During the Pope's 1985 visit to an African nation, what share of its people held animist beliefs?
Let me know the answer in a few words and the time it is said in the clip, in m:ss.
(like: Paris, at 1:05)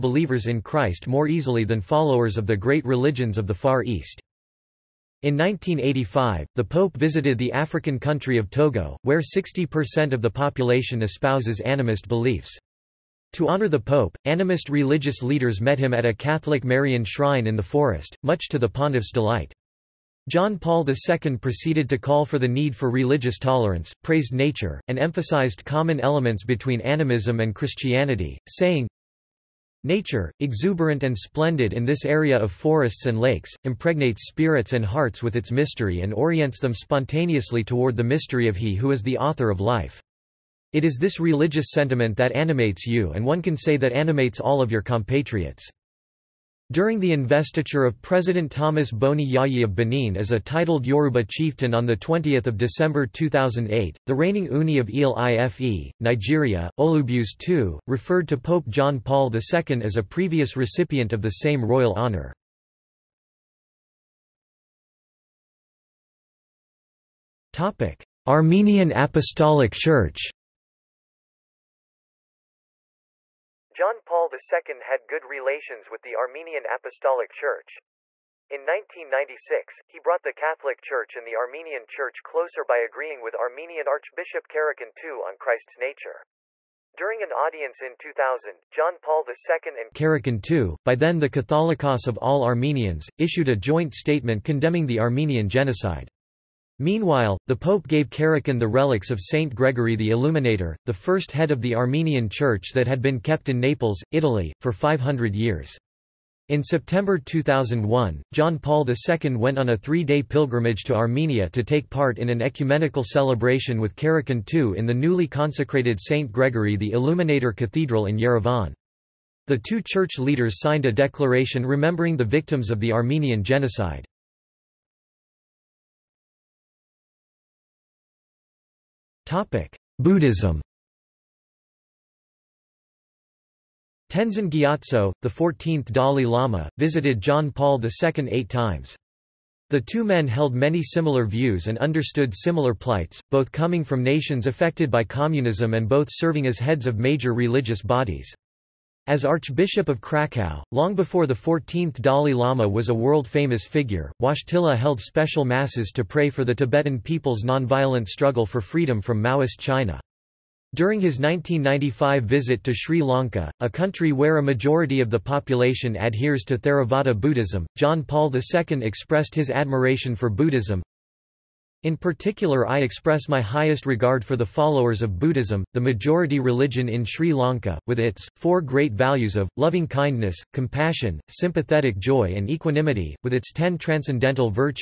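60%, at 0:09.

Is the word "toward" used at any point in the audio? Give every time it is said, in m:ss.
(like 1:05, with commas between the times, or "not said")
0:37.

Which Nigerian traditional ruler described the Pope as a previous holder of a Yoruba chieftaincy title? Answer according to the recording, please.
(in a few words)
Olubuse II.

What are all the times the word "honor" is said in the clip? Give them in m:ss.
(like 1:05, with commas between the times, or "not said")
0:13, 1:01.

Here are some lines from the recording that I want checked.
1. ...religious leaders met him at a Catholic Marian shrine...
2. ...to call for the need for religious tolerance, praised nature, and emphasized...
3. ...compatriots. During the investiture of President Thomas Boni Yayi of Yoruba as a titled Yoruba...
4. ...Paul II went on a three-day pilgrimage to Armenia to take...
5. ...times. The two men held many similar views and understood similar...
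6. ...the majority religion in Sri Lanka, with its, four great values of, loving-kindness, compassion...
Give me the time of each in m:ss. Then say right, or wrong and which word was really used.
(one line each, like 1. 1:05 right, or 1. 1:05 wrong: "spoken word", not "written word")
1. 0:14 right
2. 0:21 right
3. 0:44 wrong: "Benin", not "Yoruba"
4. 1:48 right
5. 2:18 right
6. 2:55 right.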